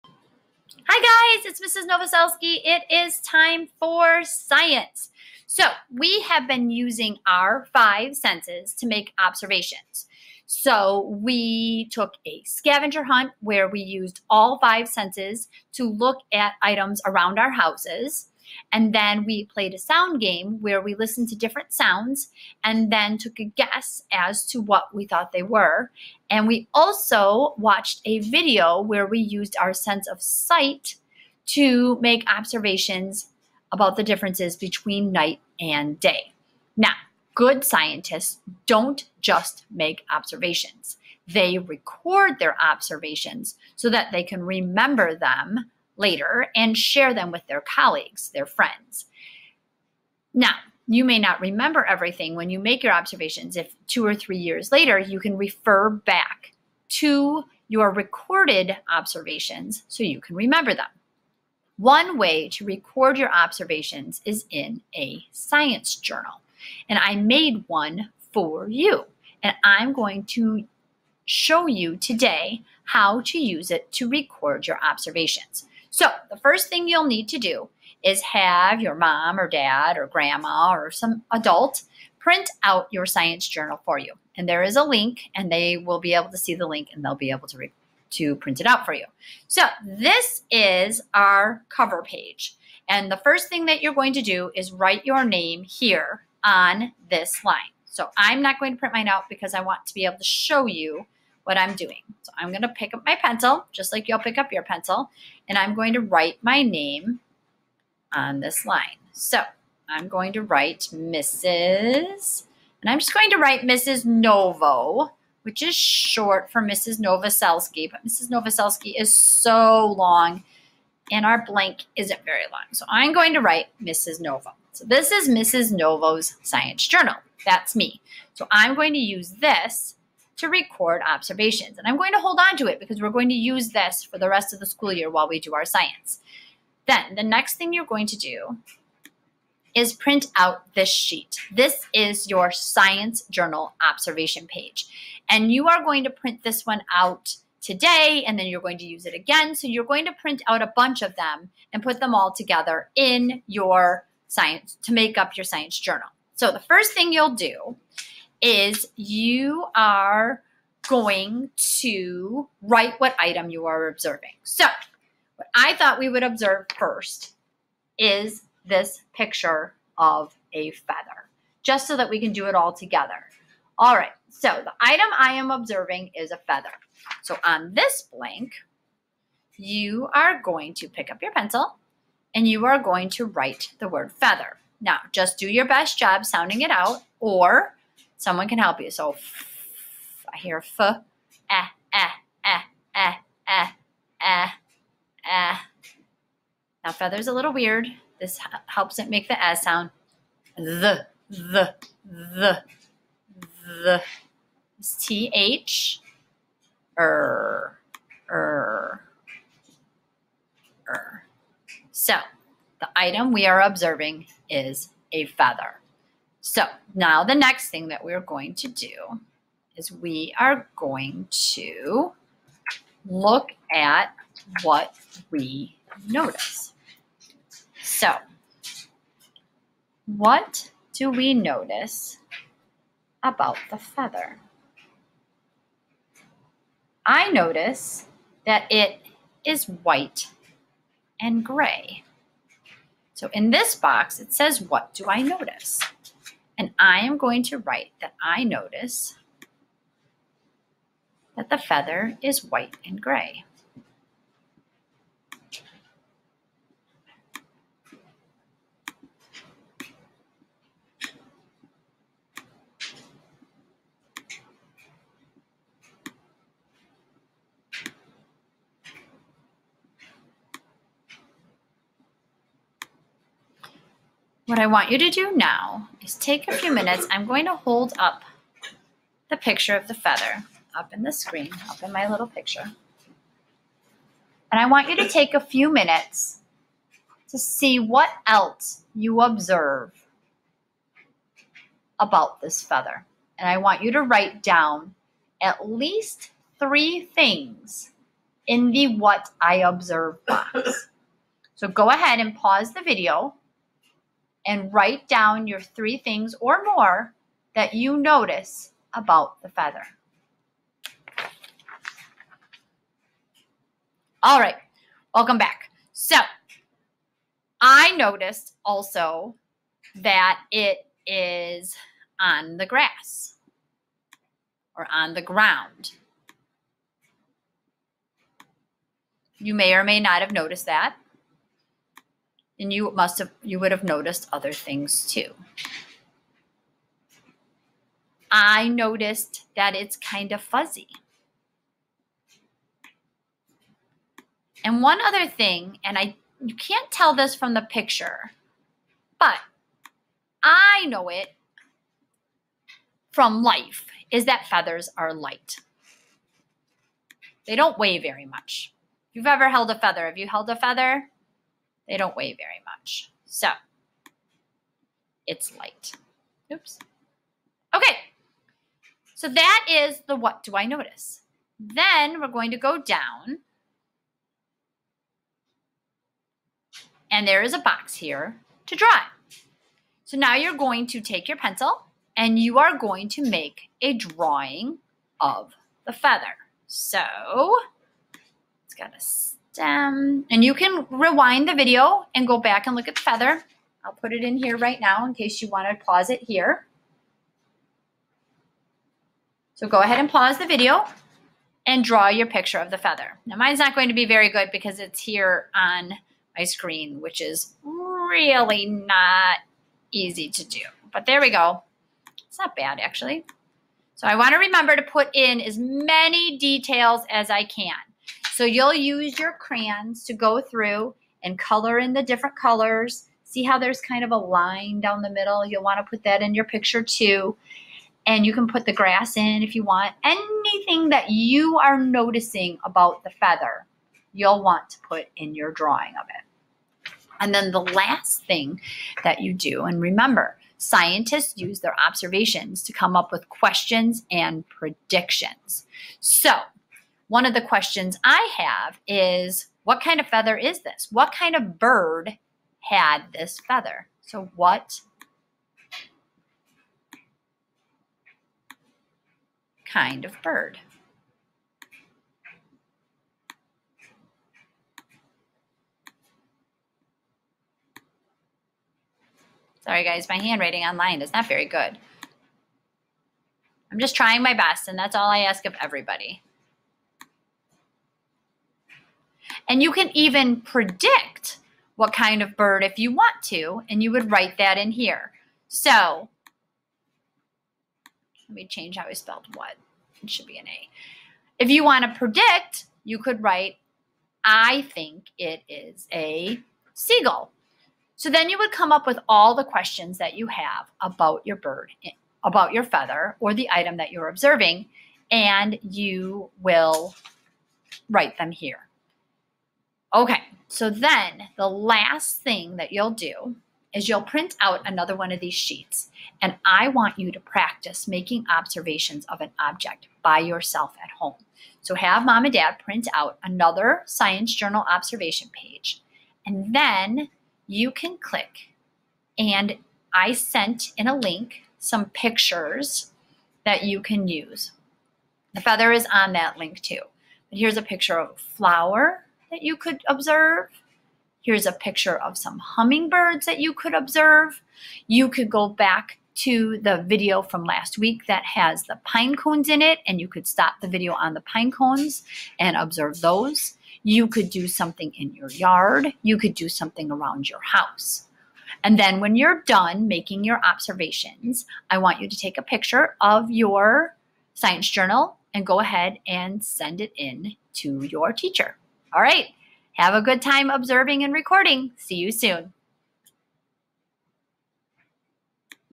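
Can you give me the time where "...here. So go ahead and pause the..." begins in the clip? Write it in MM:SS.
06:36.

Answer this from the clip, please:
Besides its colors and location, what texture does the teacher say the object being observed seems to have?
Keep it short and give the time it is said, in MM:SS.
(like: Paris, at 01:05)
fuzzy, at 05:40.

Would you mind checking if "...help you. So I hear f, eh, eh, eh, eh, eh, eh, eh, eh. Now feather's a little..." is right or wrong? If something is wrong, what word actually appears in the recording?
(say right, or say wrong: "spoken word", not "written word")
right.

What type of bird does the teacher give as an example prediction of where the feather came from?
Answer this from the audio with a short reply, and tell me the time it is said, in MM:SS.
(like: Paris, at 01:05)
a seagull, at 08:15.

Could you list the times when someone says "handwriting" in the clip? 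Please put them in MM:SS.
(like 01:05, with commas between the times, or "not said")
07:50.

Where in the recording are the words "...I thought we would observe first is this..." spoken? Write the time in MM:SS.
02:45.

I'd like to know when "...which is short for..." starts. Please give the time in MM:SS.
01:55.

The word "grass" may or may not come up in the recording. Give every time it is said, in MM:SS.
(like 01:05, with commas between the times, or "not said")
05:22, 07:08.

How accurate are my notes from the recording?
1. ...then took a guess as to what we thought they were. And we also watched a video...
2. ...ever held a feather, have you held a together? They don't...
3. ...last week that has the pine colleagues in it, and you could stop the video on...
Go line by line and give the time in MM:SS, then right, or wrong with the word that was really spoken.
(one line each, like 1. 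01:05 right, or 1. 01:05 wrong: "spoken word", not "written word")
1. 00:22 right
2. 05:59 wrong: "feather", not "together"
3. 09:07 wrong: "cones", not "colleagues".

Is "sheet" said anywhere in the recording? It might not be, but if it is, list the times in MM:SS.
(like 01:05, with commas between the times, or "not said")
02:20, 08:35.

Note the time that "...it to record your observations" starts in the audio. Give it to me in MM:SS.
01:13.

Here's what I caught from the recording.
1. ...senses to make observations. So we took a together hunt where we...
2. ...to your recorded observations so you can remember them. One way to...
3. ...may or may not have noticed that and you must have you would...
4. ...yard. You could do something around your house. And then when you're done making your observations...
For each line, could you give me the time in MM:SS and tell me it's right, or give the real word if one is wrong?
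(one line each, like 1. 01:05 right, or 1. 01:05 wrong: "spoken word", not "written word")
1. 00:08 wrong: "scavenger", not "together"
2. 00:57 right
3. 05:29 right
4. 09:15 right.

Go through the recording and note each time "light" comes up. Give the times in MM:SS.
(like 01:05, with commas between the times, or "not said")
05:55, 06:05.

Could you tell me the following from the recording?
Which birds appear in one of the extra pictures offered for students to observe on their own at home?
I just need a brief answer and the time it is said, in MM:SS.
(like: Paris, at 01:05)
hummingbirds, at 09:02.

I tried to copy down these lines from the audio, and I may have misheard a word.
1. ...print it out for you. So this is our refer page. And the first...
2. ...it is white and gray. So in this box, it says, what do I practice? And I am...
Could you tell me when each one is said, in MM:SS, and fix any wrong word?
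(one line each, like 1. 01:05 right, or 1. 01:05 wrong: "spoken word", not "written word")
1. 01:28 wrong: "cover", not "refer"
2. 03:58 wrong: "notice", not "practice".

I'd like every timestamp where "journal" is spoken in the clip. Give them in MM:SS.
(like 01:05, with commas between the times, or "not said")
01:05, 01:23, 02:06, 02:23, 02:35, 08:44, 09:24.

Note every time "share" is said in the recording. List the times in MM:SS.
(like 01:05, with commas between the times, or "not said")
00:46.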